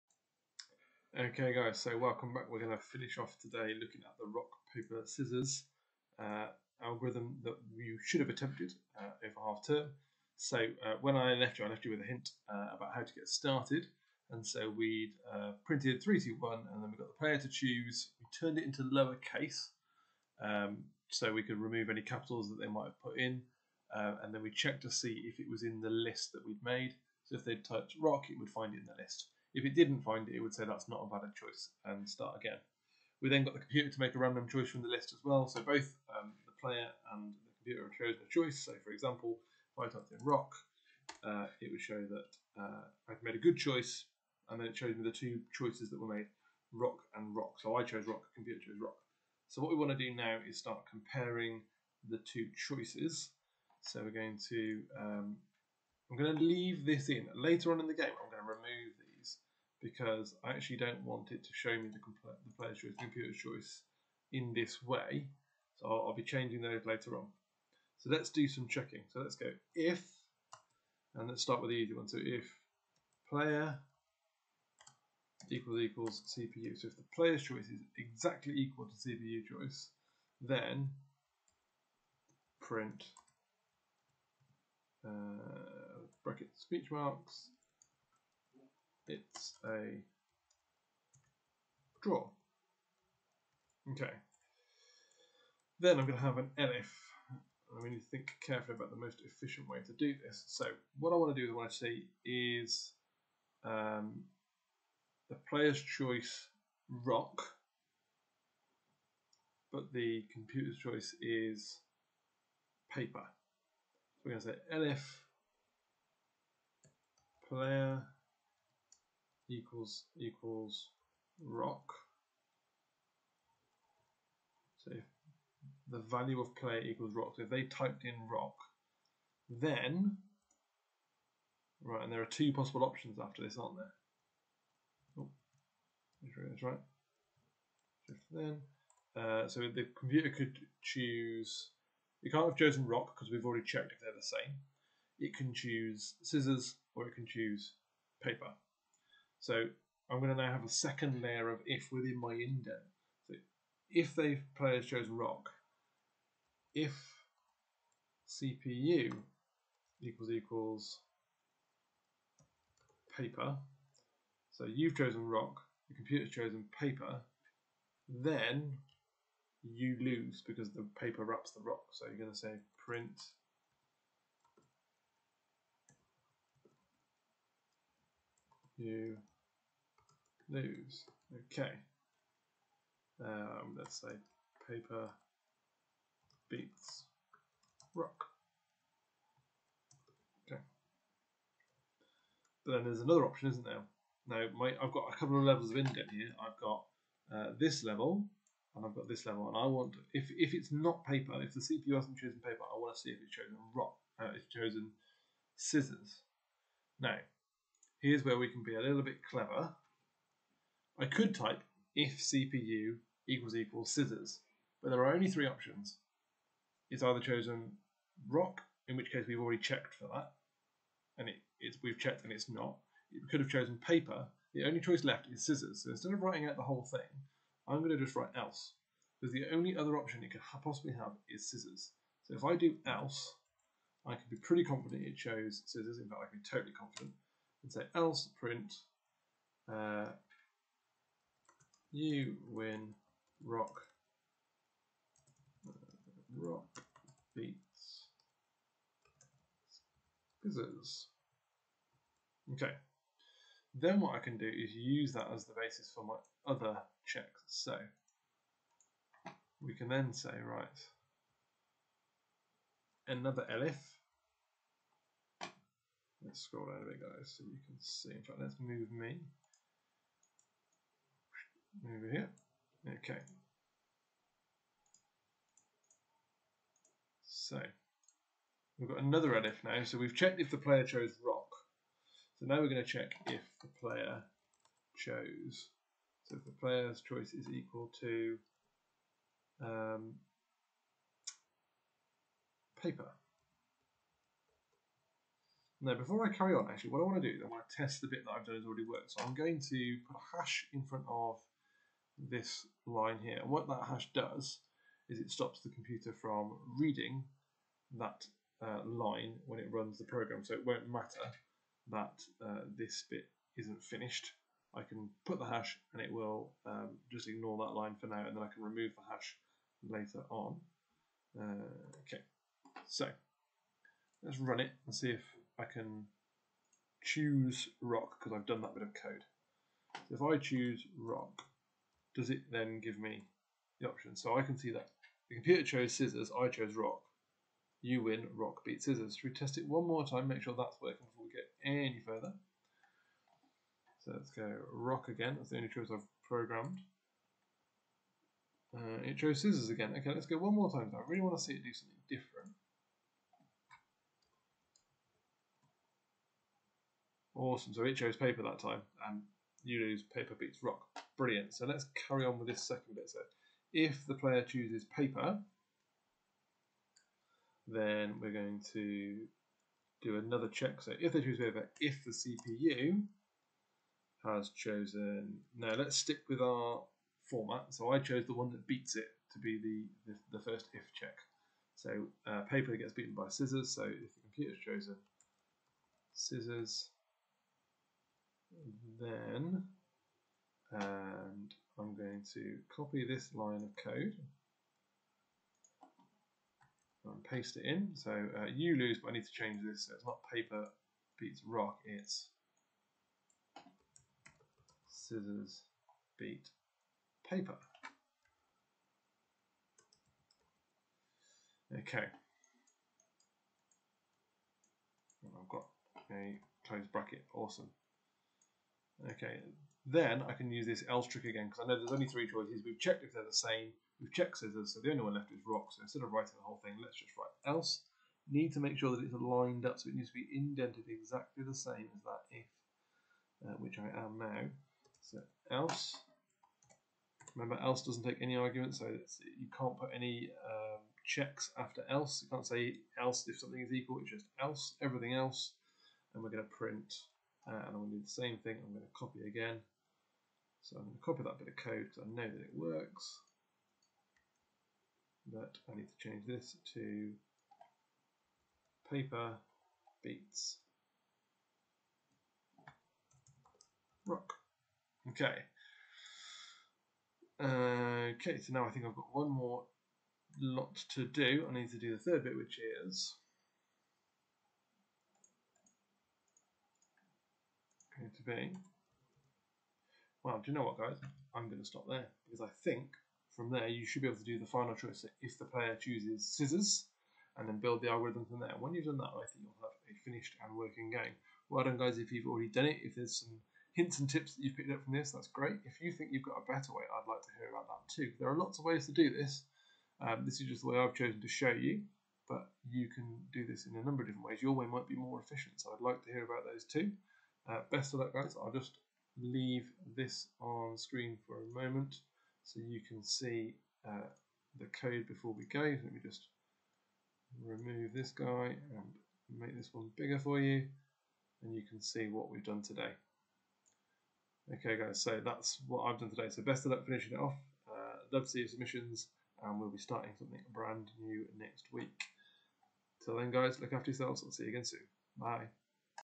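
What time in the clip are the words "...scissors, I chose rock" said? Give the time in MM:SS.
05:35.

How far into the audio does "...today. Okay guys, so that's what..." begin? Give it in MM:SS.
08:42.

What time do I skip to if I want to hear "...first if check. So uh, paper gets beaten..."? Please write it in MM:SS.
06:20.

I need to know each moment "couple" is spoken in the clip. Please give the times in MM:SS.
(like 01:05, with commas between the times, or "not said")
03:15.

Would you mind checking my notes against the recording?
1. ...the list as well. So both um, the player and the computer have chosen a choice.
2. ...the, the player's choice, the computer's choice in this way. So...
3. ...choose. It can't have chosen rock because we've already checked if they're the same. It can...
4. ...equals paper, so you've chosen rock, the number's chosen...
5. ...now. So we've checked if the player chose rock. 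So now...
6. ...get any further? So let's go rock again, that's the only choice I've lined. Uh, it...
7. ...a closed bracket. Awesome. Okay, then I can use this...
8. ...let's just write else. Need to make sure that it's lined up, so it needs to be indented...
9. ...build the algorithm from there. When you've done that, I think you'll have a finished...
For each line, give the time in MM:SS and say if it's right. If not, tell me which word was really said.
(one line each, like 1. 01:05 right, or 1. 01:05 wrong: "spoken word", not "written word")
1. 00:34 right
2. 01:01 right
3. 02:20 right
4. 02:40 wrong: "computer", not "number"
5. 04:39 right
6. 05:41 wrong: "programmed", not "lined"
7. 06:56 right
8. 07:06 right
9. 08:07 right.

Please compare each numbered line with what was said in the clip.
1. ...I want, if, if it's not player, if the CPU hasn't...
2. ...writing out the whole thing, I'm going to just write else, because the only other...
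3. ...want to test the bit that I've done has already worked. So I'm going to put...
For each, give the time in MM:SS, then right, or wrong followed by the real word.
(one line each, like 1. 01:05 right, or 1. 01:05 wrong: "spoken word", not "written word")
1. 03:19 wrong: "paper", not "player"
2. 03:46 right
3. 04:57 right.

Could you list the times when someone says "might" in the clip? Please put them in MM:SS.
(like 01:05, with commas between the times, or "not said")
00:22, 08:24.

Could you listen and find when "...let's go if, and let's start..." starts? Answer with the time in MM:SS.
01:09.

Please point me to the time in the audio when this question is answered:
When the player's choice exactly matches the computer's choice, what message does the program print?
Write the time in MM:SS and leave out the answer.
01:29.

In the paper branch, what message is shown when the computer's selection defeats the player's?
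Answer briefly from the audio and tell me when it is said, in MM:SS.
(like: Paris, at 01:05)
scissors beat paper, at 06:44.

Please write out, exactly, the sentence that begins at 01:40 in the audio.
So what I want to do is what I see is um, the player's choice rock, but the computer's choice is paper.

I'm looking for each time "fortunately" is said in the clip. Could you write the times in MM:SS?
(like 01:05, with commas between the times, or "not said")
not said.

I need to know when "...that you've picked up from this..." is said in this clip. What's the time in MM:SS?
08:14.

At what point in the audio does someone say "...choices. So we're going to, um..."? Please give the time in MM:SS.
00:52.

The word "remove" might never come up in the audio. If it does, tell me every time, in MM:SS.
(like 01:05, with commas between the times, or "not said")
00:21, 00:58, 05:18, 08:37.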